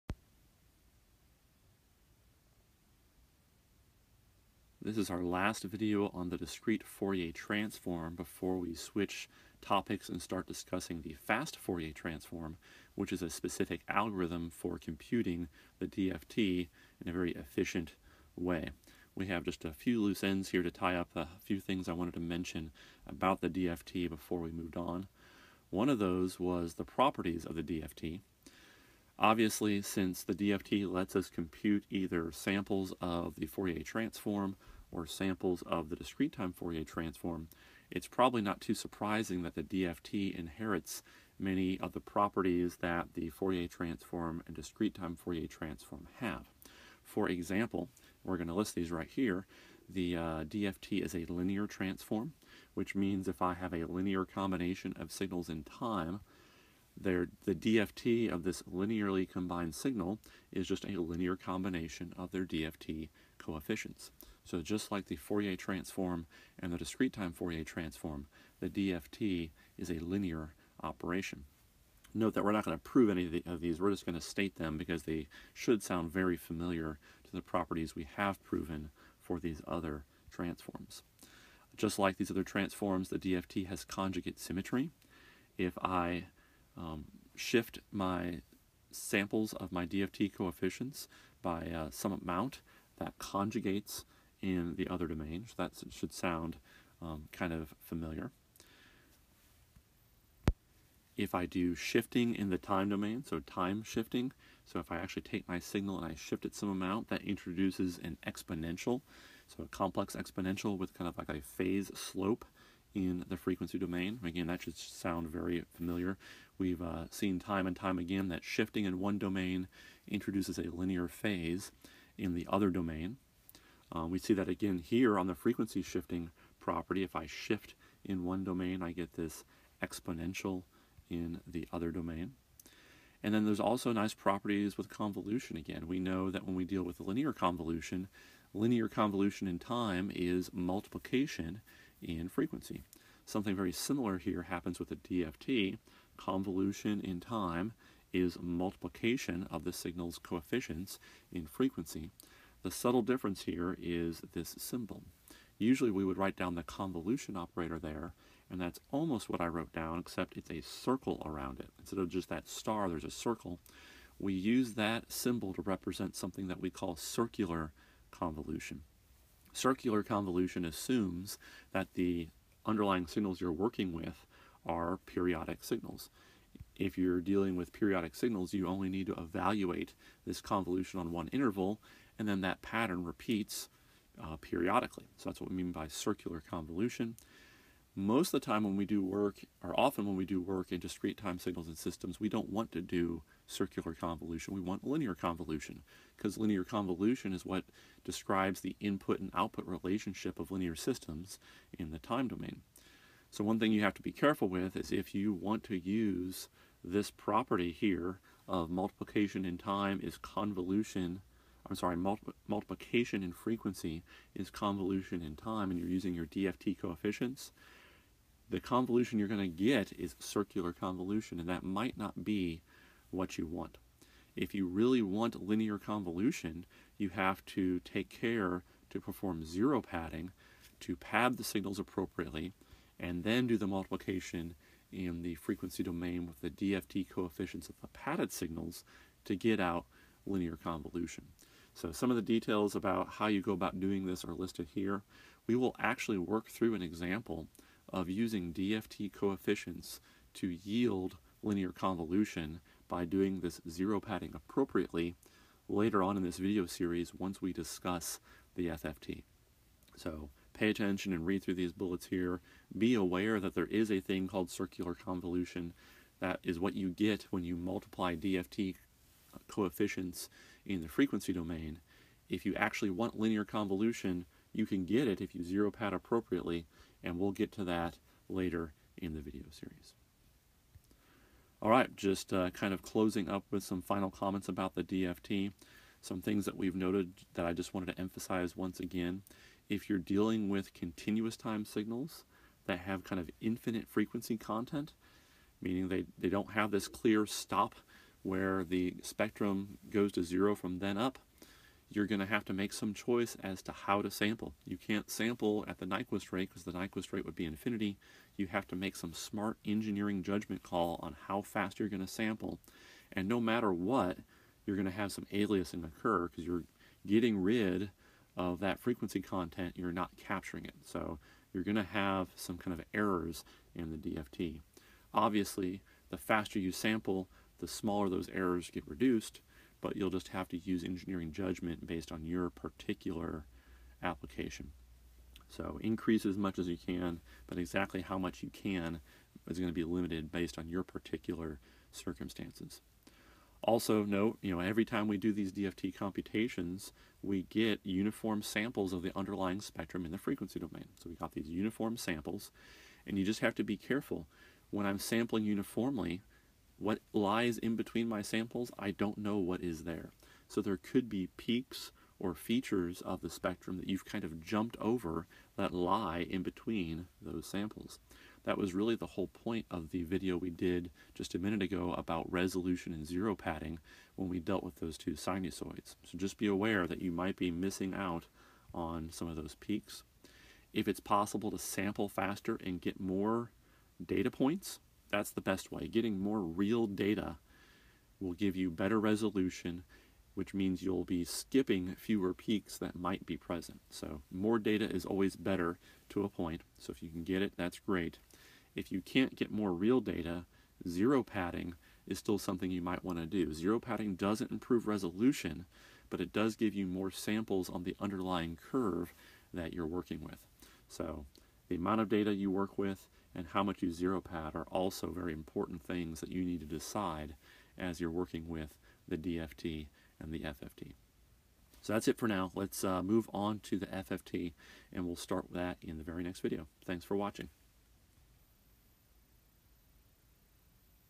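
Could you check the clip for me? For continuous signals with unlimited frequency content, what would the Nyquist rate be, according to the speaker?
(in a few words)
Infinity.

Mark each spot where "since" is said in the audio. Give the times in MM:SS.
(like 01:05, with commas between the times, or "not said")
00:29.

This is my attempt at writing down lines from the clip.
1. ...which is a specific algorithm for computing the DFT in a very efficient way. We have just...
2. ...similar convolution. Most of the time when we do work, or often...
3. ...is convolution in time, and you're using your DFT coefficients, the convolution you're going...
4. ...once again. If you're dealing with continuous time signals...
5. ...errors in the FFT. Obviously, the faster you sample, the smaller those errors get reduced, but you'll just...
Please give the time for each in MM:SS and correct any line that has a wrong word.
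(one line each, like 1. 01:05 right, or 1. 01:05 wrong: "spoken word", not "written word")
1. 00:12 right
2. 03:05 wrong: "circular", not "similar"
3. 03:34 right
4. 04:48 right
5. 05:22 wrong: "DFT", not "FFT".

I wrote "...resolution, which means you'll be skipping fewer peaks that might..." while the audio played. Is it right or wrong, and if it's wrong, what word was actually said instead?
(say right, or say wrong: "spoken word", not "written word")
right.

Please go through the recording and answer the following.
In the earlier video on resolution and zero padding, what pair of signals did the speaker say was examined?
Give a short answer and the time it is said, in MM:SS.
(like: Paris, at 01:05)
Two sinusoids, at 06:14.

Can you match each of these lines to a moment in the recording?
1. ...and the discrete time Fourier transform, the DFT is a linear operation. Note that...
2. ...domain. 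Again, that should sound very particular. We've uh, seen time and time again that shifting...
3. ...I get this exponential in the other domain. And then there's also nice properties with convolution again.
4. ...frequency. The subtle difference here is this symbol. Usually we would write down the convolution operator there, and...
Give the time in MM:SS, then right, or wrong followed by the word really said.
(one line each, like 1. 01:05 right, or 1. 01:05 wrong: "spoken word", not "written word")
1. 01:06 right
2. 01:53 wrong: "familiar", not "particular"
3. 02:08 right
4. 02:31 right.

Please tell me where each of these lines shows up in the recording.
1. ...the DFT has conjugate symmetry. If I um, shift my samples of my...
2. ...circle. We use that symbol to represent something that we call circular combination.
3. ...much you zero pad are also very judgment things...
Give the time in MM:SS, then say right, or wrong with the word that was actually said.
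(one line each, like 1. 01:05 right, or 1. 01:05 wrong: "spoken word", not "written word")
1. 01:23 right
2. 02:43 wrong: "convolution", not "combination"
3. 06:53 wrong: "important", not "judgment".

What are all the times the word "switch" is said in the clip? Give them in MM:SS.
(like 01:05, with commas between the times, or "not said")
00:08.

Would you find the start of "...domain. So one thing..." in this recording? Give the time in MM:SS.
03:22.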